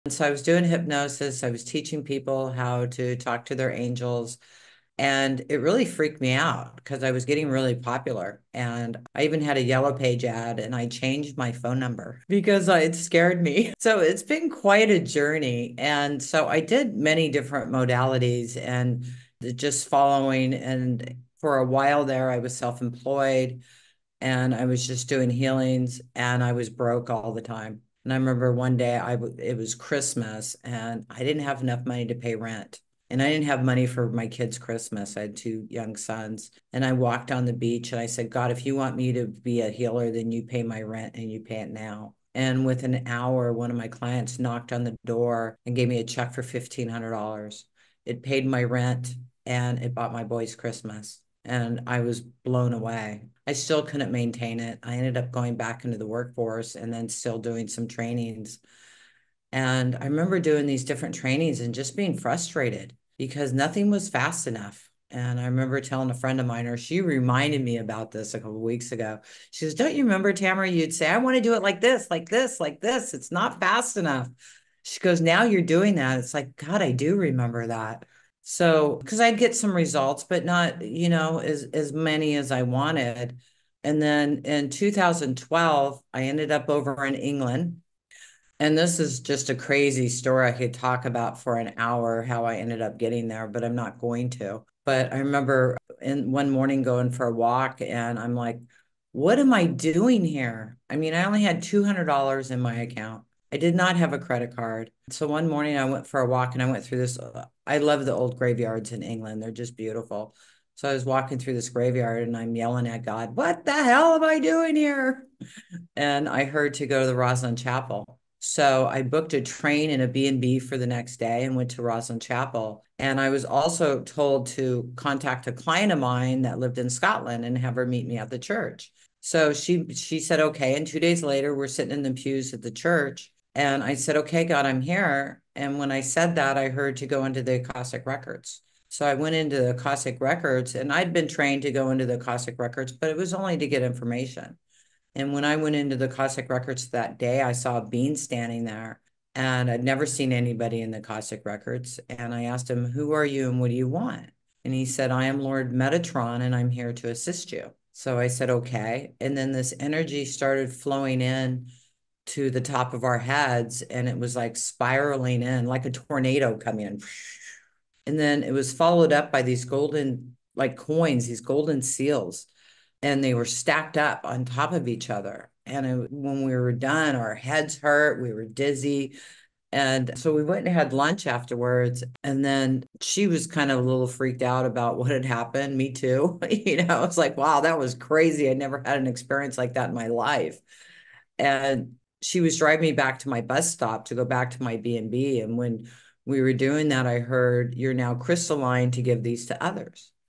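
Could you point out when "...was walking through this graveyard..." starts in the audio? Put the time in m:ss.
1:50.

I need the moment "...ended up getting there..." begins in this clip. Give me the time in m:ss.
1:32.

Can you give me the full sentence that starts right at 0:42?
And within an hour, one of my clients knocked on the door and gave me a check for $1,500.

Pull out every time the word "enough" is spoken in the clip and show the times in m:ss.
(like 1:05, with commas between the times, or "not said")
0:31, 1:04, 1:13.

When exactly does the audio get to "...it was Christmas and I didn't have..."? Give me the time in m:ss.
0:29.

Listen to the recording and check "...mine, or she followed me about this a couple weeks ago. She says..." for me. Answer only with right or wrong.
wrong.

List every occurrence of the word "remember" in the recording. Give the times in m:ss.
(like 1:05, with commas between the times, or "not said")
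0:28, 1:00, 1:05, 1:10, 1:17, 1:35.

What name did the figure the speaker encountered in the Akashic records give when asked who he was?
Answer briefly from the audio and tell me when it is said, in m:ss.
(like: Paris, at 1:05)
Lord Metatron, at 2:35.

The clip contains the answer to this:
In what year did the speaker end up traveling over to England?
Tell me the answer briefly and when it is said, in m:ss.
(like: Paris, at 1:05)
2012, at 1:24.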